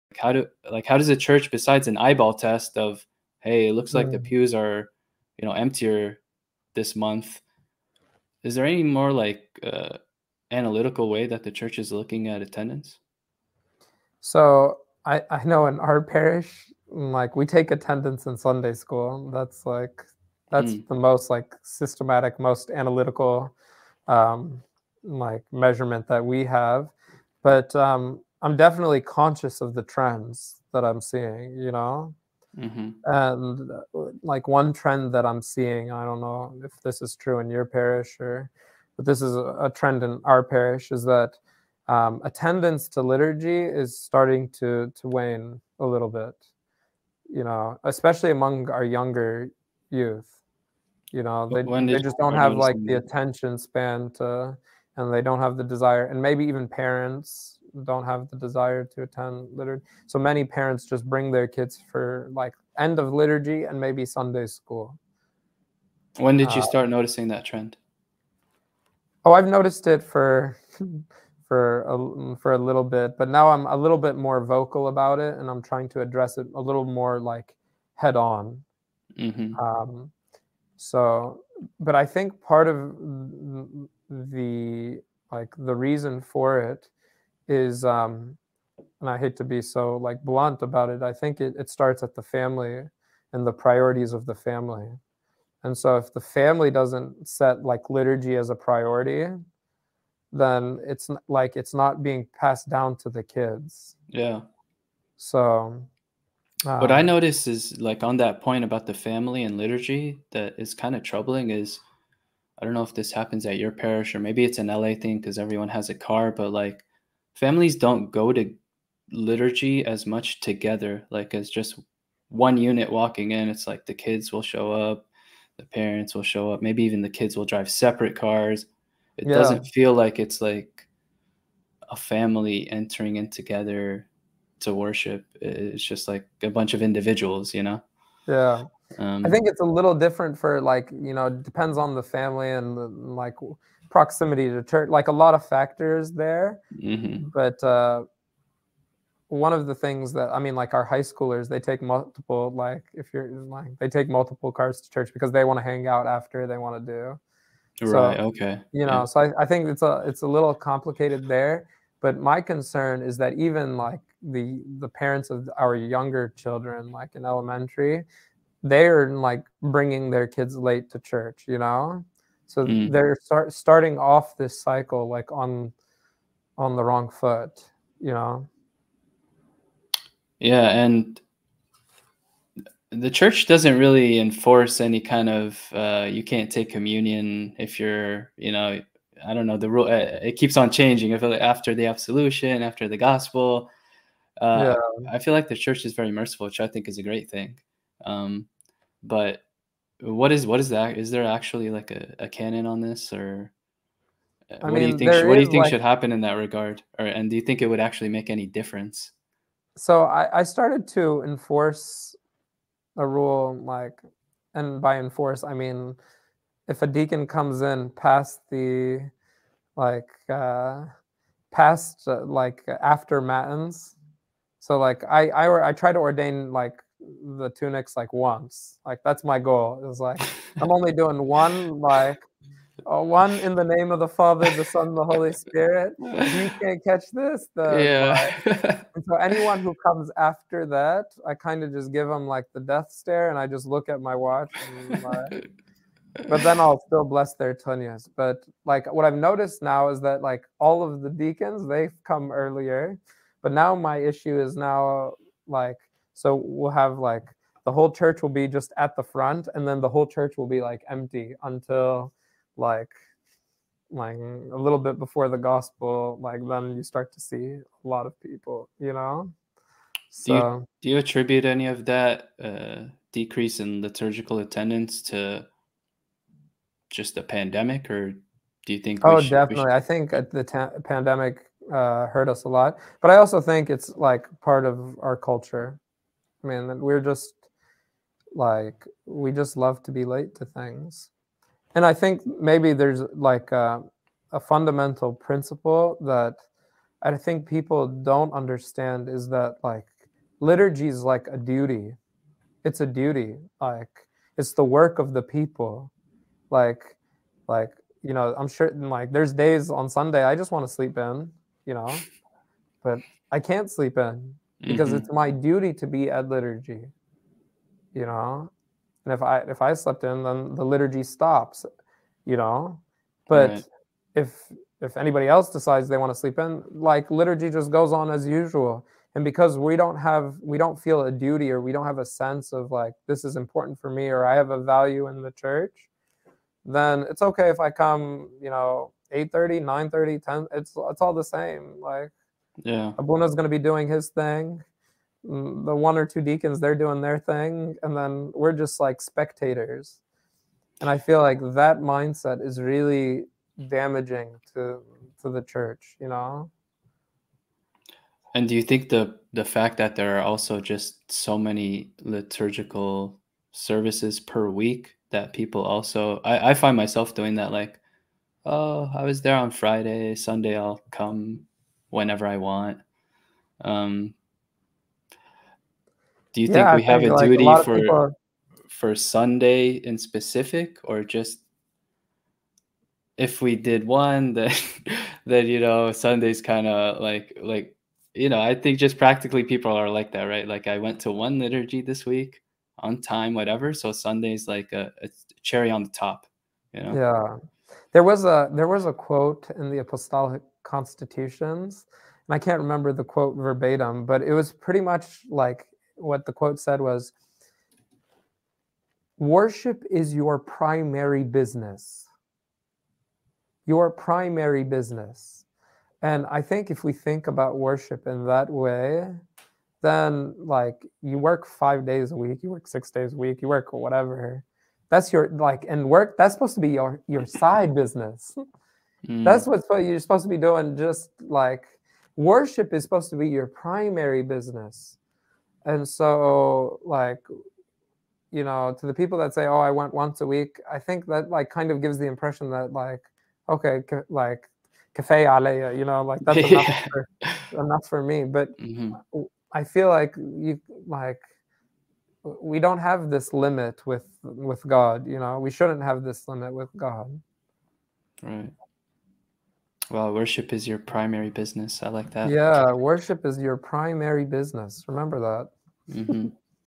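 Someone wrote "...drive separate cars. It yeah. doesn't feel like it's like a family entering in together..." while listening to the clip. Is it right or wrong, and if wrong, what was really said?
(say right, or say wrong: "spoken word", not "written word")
right.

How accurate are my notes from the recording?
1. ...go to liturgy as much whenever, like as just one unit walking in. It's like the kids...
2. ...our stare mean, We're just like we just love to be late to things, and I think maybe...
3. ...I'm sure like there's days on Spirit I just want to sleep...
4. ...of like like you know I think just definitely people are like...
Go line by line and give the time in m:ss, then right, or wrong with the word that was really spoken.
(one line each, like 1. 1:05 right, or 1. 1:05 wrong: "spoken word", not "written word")
1. 1:58 wrong: "together", not "whenever"
2. 4:45 wrong: "culture", not "stare"
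3. 5:08 wrong: "Sunday", not "Spirit"
4. 6:26 wrong: "practically", not "definitely".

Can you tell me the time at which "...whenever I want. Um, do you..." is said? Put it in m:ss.
6:11.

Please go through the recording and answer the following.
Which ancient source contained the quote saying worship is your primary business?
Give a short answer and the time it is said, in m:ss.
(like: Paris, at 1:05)
apostolic constitutions, at 6:39.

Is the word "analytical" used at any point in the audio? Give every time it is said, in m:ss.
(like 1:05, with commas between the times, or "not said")
0:10, 0:22.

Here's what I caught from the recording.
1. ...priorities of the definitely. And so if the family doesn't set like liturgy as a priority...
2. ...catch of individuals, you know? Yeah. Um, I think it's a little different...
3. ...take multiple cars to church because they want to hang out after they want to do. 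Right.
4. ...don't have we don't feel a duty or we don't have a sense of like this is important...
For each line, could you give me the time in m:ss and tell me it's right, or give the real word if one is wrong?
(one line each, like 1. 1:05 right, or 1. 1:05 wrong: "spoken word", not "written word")
1. 1:33 wrong: "family", not "definitely"
2. 2:16 wrong: "bunch", not "catch"
3. 2:33 right
4. 5:29 right.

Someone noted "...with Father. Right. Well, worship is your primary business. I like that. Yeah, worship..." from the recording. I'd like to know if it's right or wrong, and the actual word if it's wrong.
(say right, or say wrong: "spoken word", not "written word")
wrong: "God", not "Father".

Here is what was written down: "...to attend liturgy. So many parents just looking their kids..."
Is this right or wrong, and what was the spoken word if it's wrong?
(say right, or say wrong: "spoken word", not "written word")
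wrong: "bring", not "looking".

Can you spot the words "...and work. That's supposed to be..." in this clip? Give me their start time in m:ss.
7:05.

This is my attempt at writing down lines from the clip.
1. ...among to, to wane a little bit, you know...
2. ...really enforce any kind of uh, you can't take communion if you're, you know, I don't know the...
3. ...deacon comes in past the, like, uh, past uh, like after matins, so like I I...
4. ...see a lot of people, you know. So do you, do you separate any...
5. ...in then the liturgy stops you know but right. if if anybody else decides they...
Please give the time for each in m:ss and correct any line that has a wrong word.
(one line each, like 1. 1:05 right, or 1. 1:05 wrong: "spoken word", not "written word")
1. 0:43 wrong: "starting", not "among"
2. 3:03 right
3. 3:36 right
4. 4:27 wrong: "attribute", not "separate"
5. 5:20 right.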